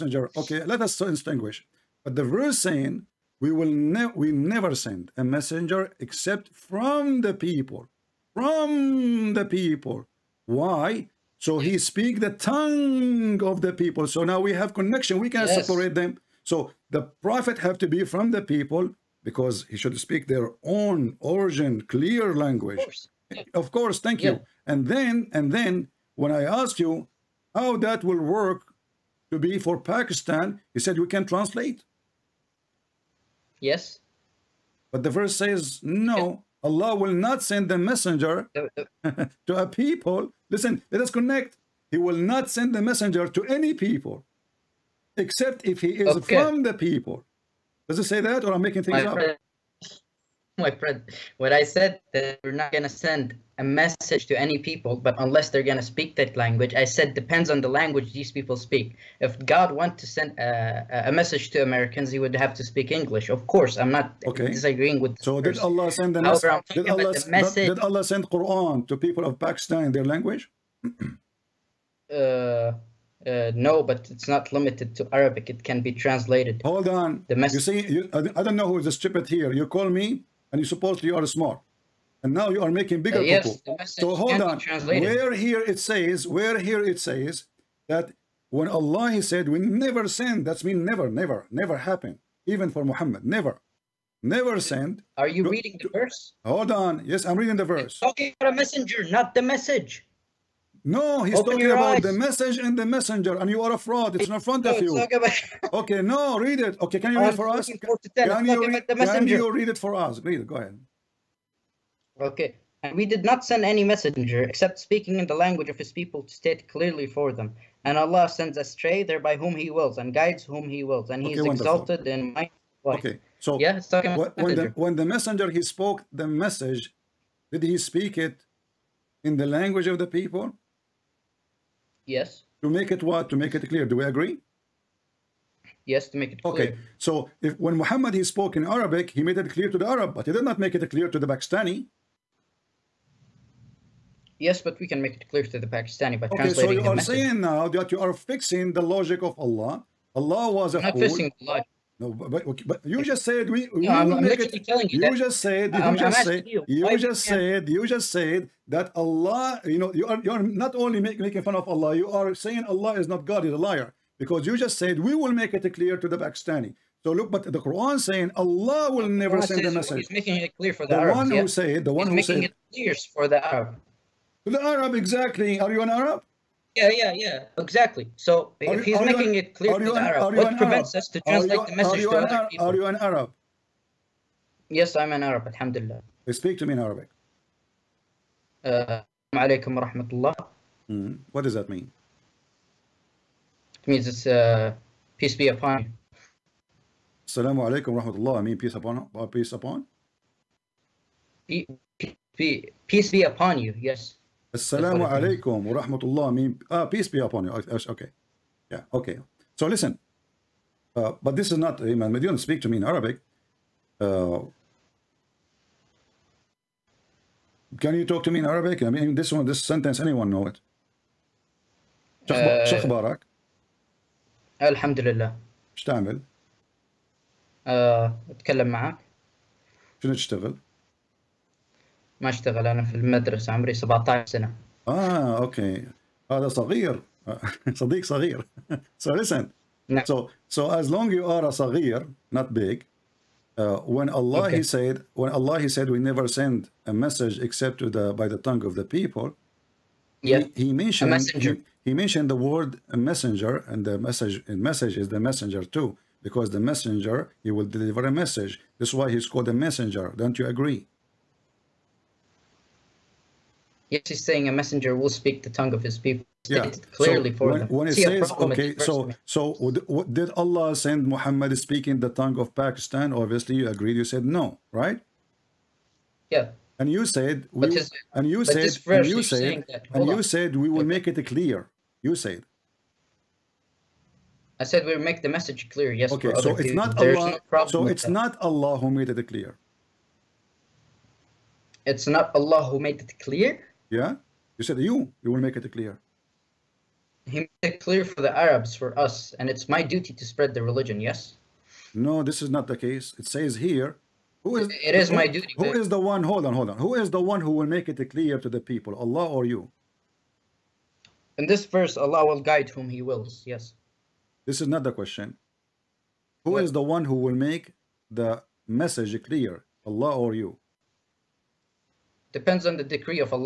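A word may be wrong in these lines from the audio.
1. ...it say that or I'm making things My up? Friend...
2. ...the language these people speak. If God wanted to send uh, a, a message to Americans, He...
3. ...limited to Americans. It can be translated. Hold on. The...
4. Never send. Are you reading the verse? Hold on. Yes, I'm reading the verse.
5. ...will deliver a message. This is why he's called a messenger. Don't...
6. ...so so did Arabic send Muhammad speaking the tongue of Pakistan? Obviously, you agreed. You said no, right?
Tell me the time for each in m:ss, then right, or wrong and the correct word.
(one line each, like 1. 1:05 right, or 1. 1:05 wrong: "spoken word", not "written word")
1. 0:47 right
2. 0:57 right
3. 1:14 wrong: "Arabic", not "Americans"
4. 1:34 right
5. 4:17 right
6. 4:28 wrong: "Allah", not "Arabic".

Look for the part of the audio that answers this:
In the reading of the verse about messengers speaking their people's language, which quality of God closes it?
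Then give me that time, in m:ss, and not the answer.
2:01.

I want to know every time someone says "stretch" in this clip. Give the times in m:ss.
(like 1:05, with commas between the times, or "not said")
not said.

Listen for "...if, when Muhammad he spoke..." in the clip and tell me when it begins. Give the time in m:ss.
2:17.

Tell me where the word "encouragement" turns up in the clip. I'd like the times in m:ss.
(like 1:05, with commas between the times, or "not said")
not said.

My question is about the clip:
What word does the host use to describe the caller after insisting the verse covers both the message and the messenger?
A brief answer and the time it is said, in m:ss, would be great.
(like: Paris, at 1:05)
A fraud, at 1:43.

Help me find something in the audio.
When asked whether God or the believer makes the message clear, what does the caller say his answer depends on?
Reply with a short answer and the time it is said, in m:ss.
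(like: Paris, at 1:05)
The decree, at 5:22.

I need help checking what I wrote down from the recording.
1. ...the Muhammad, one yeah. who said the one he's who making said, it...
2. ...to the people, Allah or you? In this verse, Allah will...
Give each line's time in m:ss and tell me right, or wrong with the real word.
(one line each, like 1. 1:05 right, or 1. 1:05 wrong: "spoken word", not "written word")
1. 2:50 wrong: "Arabs", not "Muhammad"
2. 5:08 right.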